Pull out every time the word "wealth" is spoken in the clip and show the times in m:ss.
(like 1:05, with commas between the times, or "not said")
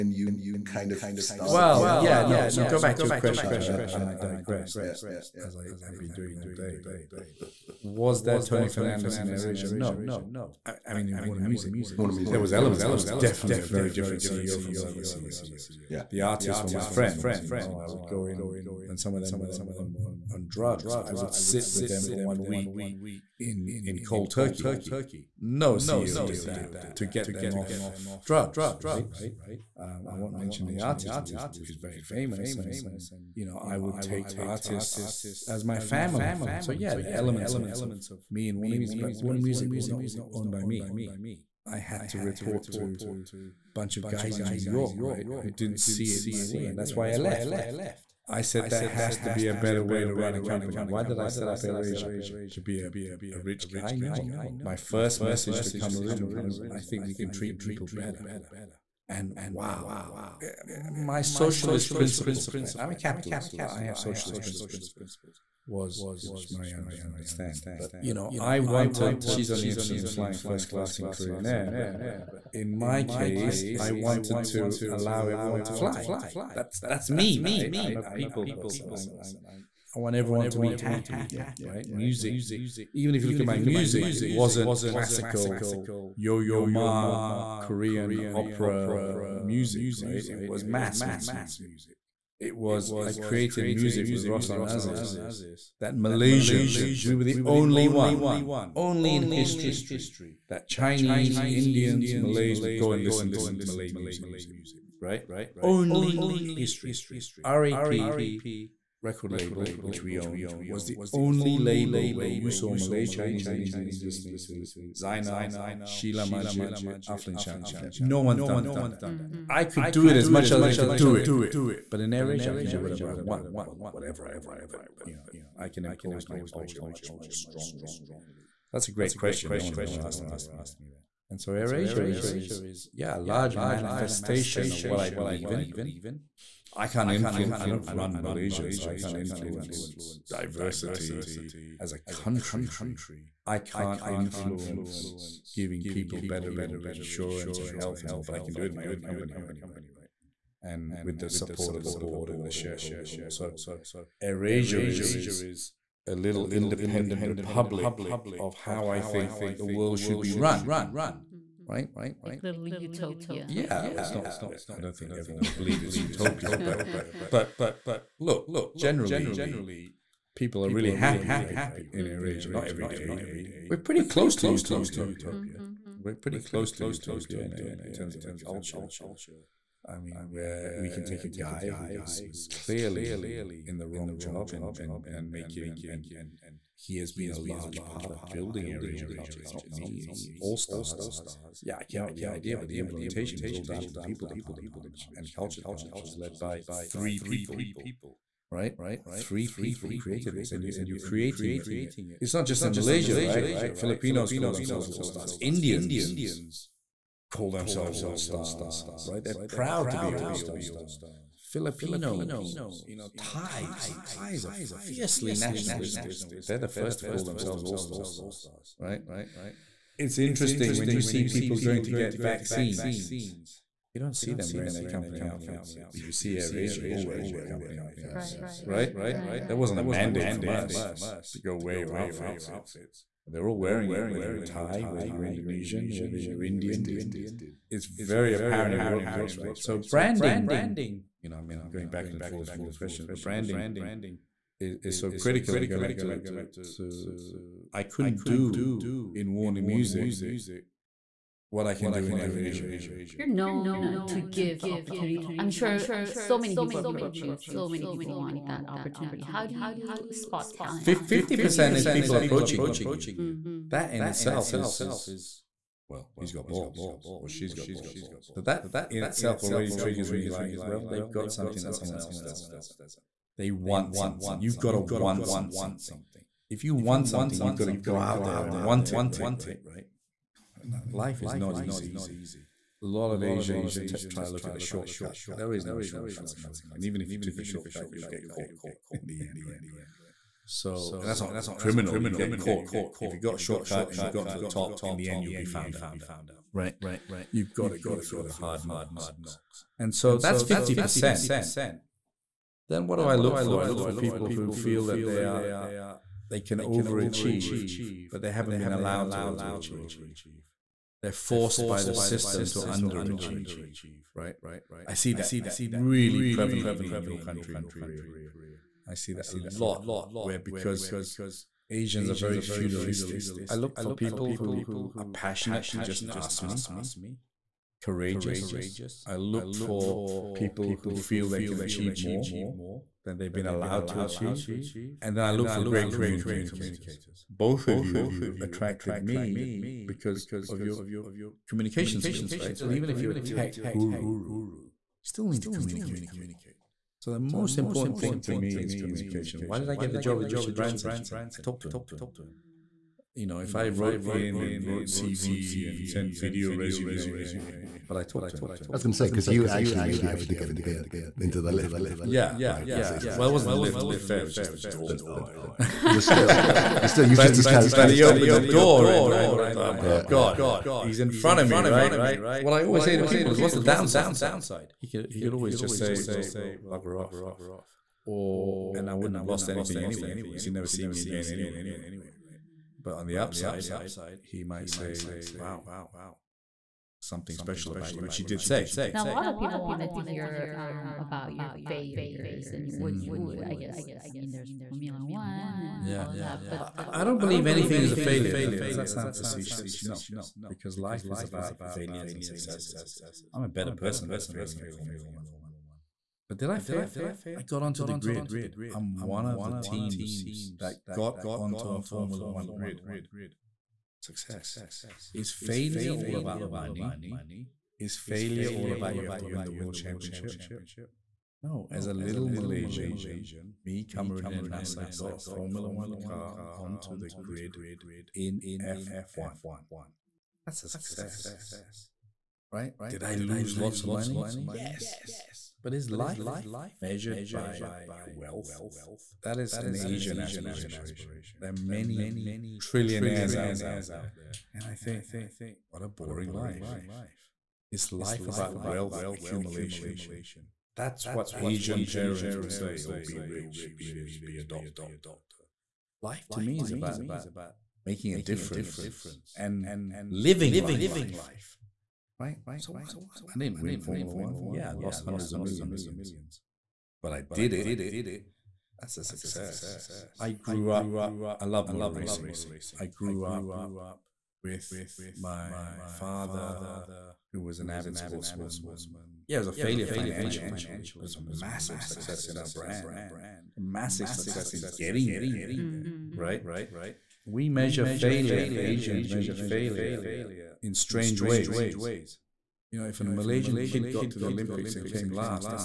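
7:18, 7:28.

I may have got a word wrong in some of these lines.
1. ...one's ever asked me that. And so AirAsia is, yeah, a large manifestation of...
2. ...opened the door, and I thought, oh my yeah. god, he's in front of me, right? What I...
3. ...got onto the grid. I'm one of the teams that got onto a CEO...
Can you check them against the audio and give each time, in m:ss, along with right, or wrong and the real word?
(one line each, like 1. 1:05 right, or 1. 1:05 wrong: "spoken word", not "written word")
1. 2:09 right
2. 6:08 right
3. 6:47 wrong: "Formula", not "CEO".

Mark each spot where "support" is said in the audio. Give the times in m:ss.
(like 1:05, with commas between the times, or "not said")
2:31.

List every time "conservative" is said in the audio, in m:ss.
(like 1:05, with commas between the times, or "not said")
not said.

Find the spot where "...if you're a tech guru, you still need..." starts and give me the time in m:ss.
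5:42.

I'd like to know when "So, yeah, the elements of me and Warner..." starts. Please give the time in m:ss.
0:36.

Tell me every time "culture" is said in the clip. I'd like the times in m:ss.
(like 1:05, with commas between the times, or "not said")
2:06, 2:58, 3:09, 3:15.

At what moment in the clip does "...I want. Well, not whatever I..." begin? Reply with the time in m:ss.
2:03.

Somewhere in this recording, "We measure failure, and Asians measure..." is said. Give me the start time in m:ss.
8:07.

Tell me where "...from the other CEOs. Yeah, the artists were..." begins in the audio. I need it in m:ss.
0:14.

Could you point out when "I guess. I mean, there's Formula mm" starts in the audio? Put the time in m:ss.
6:33.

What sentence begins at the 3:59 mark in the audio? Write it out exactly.
So branding, you know, I mean, I'm going back and forth from your questions, but branding is, is so critical.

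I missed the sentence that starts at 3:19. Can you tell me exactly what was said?
Three people created this, and you and you're creating it.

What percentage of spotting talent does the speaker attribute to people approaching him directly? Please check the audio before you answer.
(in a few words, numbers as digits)
50%.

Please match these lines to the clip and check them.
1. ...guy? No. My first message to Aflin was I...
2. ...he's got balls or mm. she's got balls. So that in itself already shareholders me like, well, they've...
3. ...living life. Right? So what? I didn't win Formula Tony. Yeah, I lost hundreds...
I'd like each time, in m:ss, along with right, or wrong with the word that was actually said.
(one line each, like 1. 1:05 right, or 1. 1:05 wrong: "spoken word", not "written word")
1. 0:53 wrong: "Cameroon", not "Aflin"
2. 4:26 wrong: "triggers", not "shareholders"
3. 7:40 wrong: "One", not "Tony".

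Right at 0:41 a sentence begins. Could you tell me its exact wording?
I had to report to a bunch of guys in New York, right, who didn't see it my way.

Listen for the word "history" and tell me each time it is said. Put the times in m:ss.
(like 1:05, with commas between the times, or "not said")
1:39, 1:46.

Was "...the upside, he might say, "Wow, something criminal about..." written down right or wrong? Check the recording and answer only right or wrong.
wrong.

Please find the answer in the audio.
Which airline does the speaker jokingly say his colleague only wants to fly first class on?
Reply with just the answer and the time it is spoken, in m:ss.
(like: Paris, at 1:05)
Korean Air, at 1:11.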